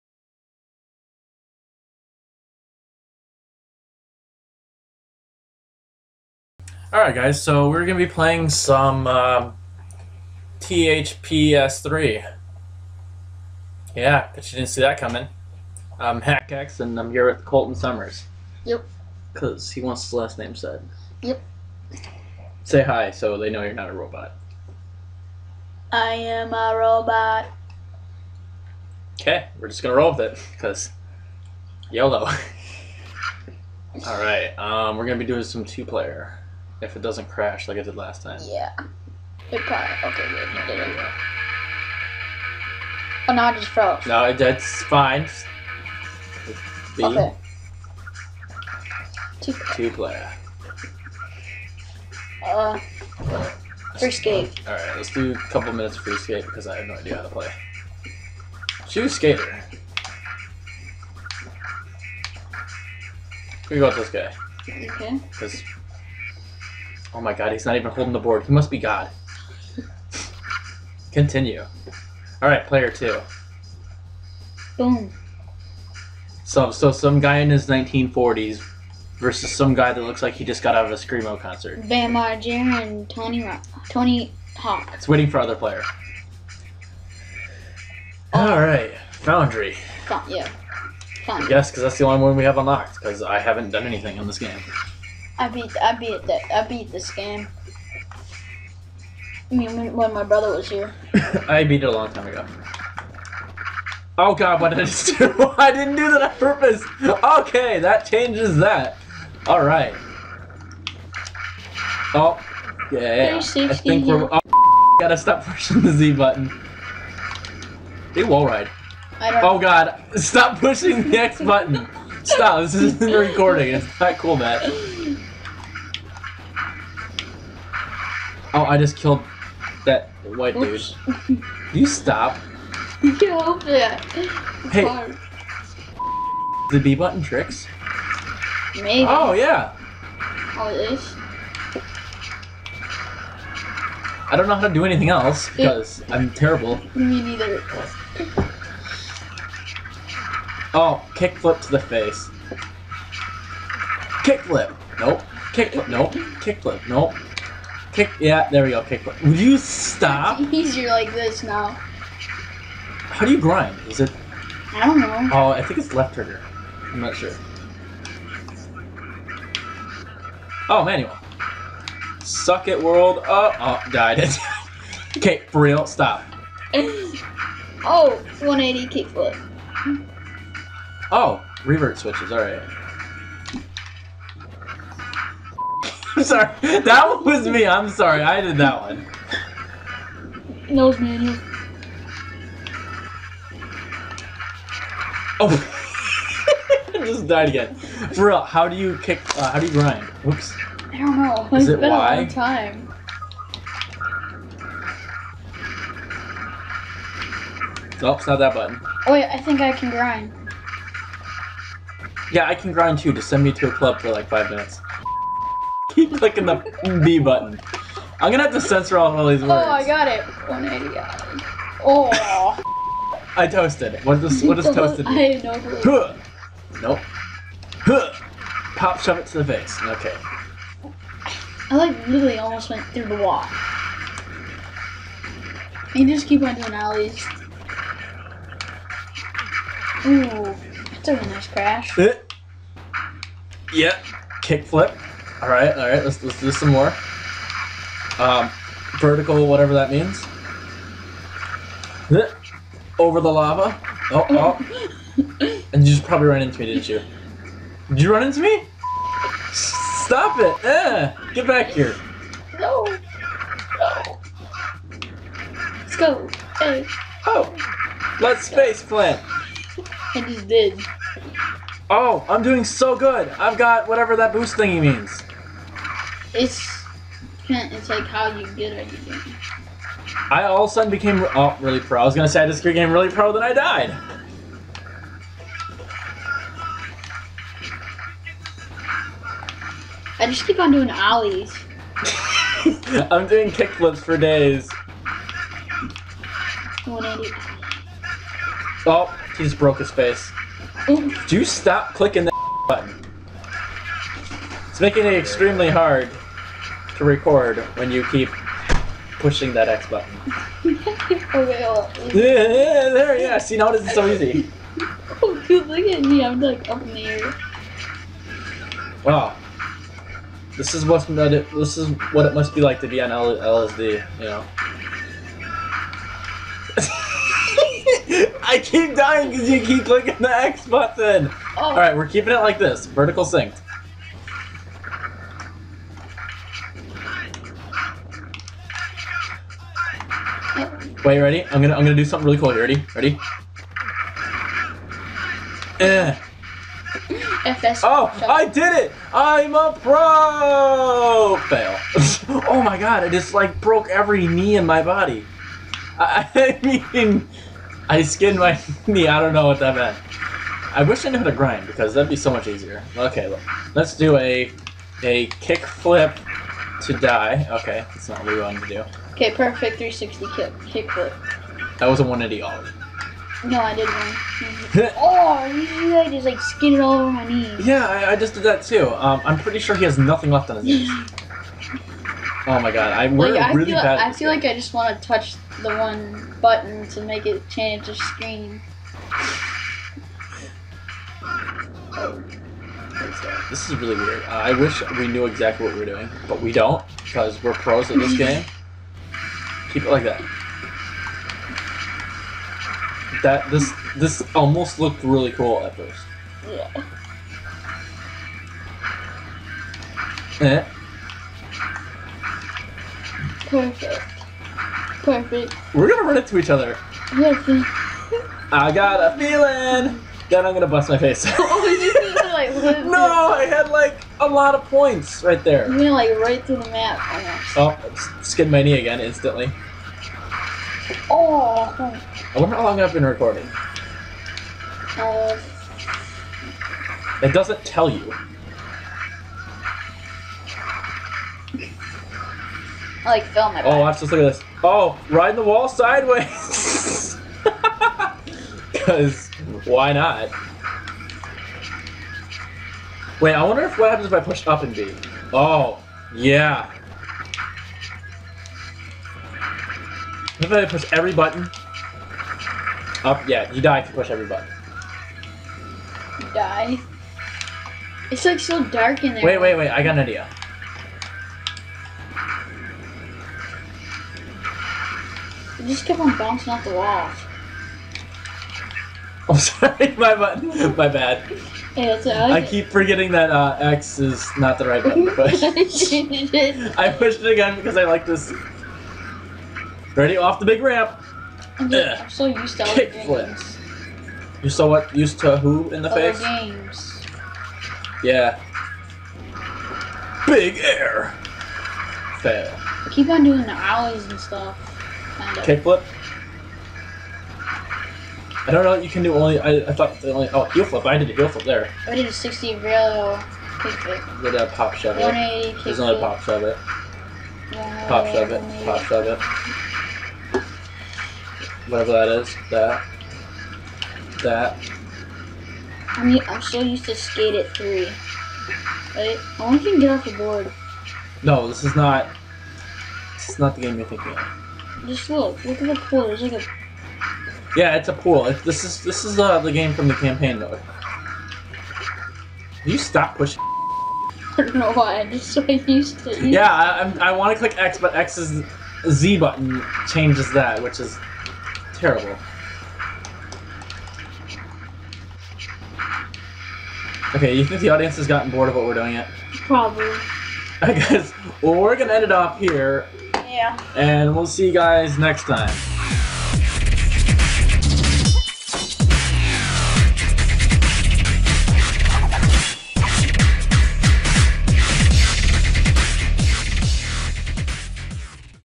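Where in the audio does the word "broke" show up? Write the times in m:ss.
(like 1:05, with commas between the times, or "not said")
4:59, 5:53.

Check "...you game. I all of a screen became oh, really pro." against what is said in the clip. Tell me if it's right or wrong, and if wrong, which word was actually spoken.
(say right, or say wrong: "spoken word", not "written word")
wrong: "sudden", not "screen".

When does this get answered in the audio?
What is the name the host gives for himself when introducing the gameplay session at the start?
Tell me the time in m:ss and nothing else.
0:16.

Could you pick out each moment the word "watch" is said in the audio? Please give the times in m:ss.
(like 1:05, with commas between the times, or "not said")
7:23.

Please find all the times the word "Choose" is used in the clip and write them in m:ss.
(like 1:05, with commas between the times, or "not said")
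0:58.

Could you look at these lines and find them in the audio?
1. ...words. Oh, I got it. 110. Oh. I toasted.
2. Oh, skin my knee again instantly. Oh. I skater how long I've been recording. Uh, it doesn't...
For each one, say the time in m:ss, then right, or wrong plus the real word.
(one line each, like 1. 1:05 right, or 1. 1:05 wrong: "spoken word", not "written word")
1. 3:39 wrong: "180", not "110"
2. 7:07 wrong: "wonder", not "skater".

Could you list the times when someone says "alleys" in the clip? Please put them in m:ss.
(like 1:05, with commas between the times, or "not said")
3:56, 4:50.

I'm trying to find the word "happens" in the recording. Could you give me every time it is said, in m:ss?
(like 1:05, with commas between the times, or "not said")
7:33.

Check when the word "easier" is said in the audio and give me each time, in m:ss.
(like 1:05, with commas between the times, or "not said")
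2:40, 6:02.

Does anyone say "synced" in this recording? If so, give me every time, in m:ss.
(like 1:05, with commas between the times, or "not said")
5:33.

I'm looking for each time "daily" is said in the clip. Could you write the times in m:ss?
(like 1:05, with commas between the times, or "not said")
not said.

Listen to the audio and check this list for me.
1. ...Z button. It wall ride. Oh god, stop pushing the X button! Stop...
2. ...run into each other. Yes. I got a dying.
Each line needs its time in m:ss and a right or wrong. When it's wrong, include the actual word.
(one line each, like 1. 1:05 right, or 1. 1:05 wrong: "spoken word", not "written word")
1. 1:55 right
2. 6:56 wrong: "feeling", not "dying".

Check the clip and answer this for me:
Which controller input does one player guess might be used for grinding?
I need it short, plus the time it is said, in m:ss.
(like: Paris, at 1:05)
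Left trigger, at 2:45.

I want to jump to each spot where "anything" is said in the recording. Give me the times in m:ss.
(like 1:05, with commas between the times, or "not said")
1:33, 2:24.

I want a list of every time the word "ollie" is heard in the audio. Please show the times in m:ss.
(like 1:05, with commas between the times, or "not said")
6:12, 8:23.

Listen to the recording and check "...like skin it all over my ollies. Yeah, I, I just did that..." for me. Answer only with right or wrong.
wrong.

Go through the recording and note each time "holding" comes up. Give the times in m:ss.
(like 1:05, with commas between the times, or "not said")
1:07.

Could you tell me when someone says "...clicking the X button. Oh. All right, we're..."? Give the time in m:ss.
5:29.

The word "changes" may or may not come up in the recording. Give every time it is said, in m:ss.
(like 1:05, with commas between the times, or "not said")
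1:48, 6:27, 9:09.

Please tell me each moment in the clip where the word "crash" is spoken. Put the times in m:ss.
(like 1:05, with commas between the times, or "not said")
0:37, 4:01.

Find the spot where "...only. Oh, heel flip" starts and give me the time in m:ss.
8:30.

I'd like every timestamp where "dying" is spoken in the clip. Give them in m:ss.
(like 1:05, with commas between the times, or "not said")
5:28.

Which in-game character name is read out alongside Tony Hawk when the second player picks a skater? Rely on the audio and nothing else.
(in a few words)
Vampire Jr.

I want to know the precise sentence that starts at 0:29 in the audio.
Okay, we're just going to roll with it because YOLO.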